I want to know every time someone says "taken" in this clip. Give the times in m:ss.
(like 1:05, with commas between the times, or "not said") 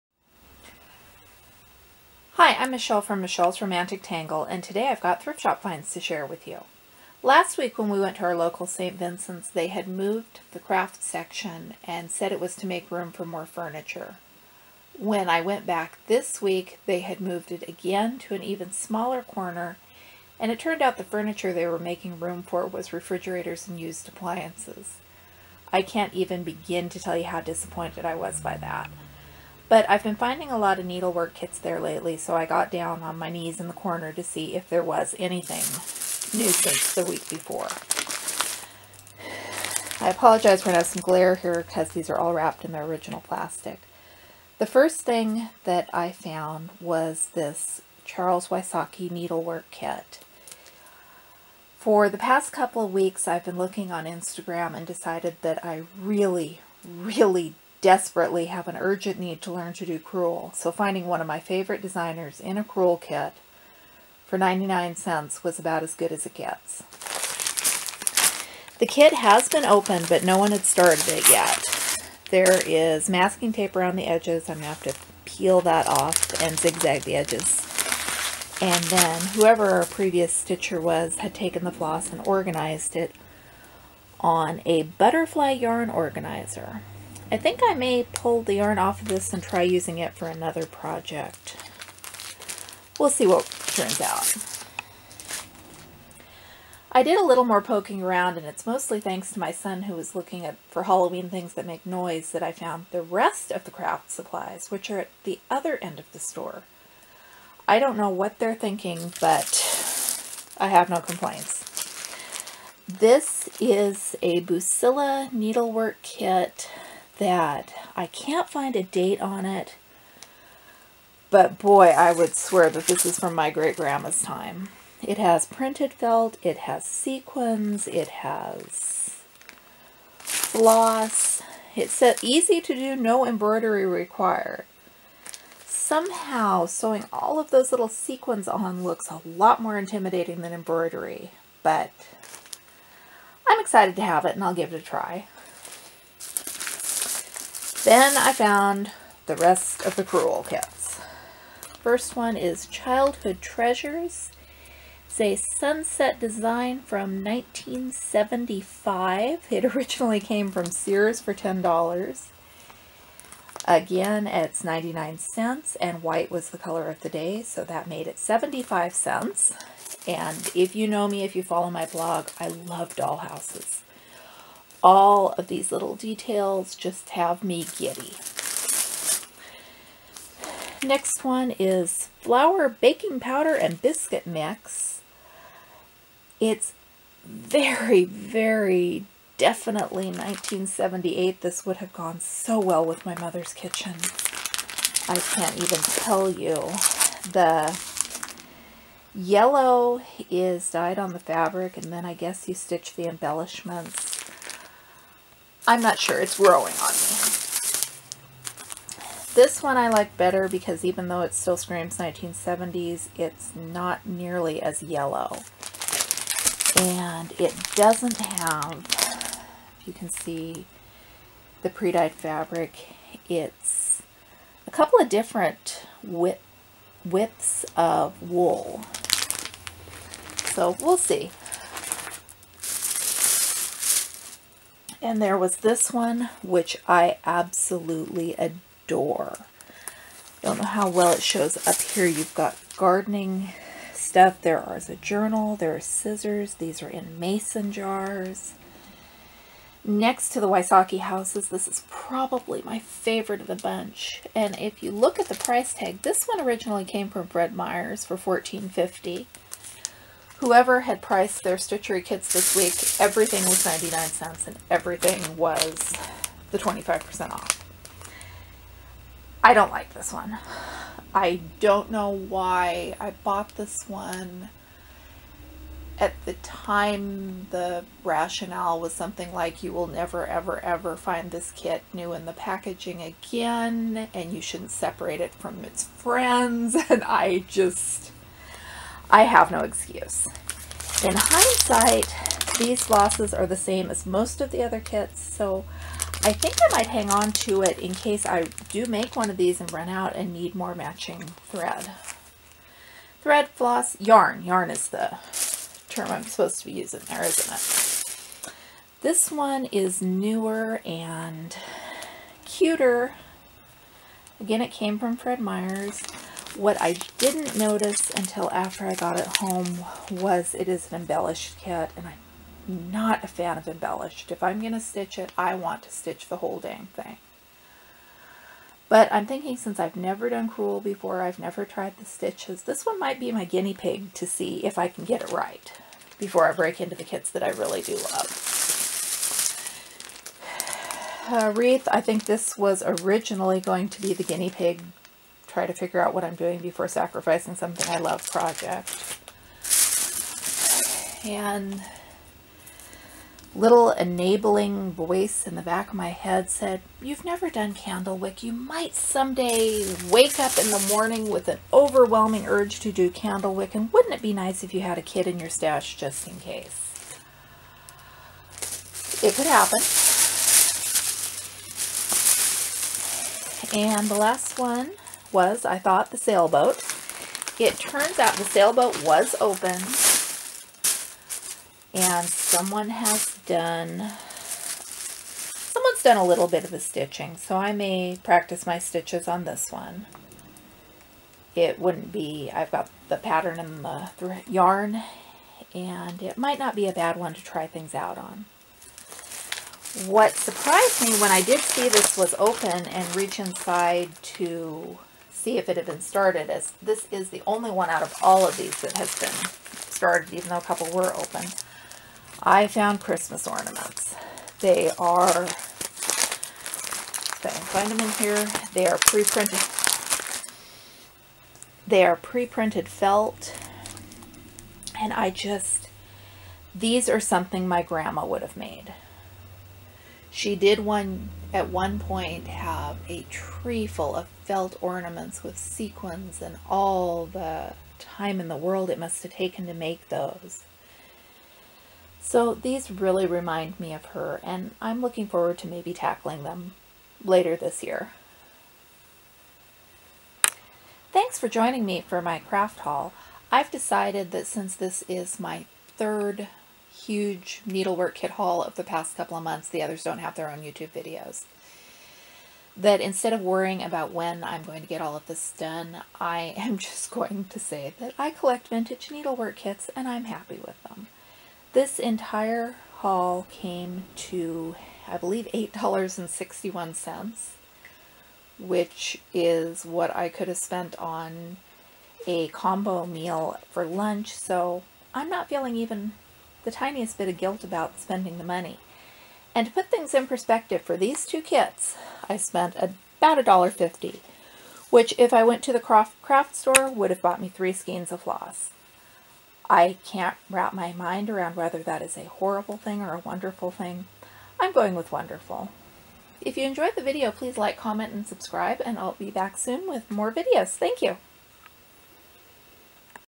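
1:21, 7:19.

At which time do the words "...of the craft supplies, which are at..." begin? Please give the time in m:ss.
1:43.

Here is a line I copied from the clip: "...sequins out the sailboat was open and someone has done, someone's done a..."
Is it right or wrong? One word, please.
wrong.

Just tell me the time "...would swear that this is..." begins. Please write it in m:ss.
2:02.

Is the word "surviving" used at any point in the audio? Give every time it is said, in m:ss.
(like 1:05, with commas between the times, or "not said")
not said.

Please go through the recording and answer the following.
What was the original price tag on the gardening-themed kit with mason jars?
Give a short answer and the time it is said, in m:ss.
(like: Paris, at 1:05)
$14.50, at 4:18.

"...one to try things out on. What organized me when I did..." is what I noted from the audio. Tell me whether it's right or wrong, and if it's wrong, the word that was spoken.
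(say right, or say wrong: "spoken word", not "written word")
wrong: "surprised", not "organized".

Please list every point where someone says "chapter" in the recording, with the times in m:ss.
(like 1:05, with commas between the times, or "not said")
not said.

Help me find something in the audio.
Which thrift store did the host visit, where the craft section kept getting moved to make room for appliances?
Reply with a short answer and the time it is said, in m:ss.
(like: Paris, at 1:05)
St. Vincent's, at 0:08.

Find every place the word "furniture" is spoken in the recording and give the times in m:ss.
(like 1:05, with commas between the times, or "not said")
0:13, 0:21.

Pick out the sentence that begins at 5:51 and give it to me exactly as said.
And little enabling voice in the back of my head said, You've never done candlewick.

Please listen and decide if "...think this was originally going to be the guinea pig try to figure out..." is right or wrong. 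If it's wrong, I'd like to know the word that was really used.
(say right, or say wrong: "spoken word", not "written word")
right.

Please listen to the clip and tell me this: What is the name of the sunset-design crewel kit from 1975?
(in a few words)
Childhood Treasures.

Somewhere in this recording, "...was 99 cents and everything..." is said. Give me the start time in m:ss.
4:23.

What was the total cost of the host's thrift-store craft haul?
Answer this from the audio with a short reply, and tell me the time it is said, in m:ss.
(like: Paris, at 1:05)
$8.61, at 7:55.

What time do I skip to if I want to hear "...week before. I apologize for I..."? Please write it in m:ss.
0:37.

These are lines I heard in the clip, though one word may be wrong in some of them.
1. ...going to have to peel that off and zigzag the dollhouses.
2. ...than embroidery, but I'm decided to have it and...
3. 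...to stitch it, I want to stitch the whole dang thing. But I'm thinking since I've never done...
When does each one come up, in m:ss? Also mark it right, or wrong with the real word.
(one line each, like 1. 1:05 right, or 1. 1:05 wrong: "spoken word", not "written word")
1. 1:14 wrong: "edges", not "dollhouses"
2. 2:20 wrong: "excited", not "decided"
3. 5:24 right.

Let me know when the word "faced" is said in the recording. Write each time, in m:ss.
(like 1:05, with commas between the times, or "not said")
not said.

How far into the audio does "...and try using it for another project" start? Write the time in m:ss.
1:29.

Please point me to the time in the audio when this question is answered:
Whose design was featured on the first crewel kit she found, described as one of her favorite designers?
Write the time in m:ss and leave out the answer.
0:48.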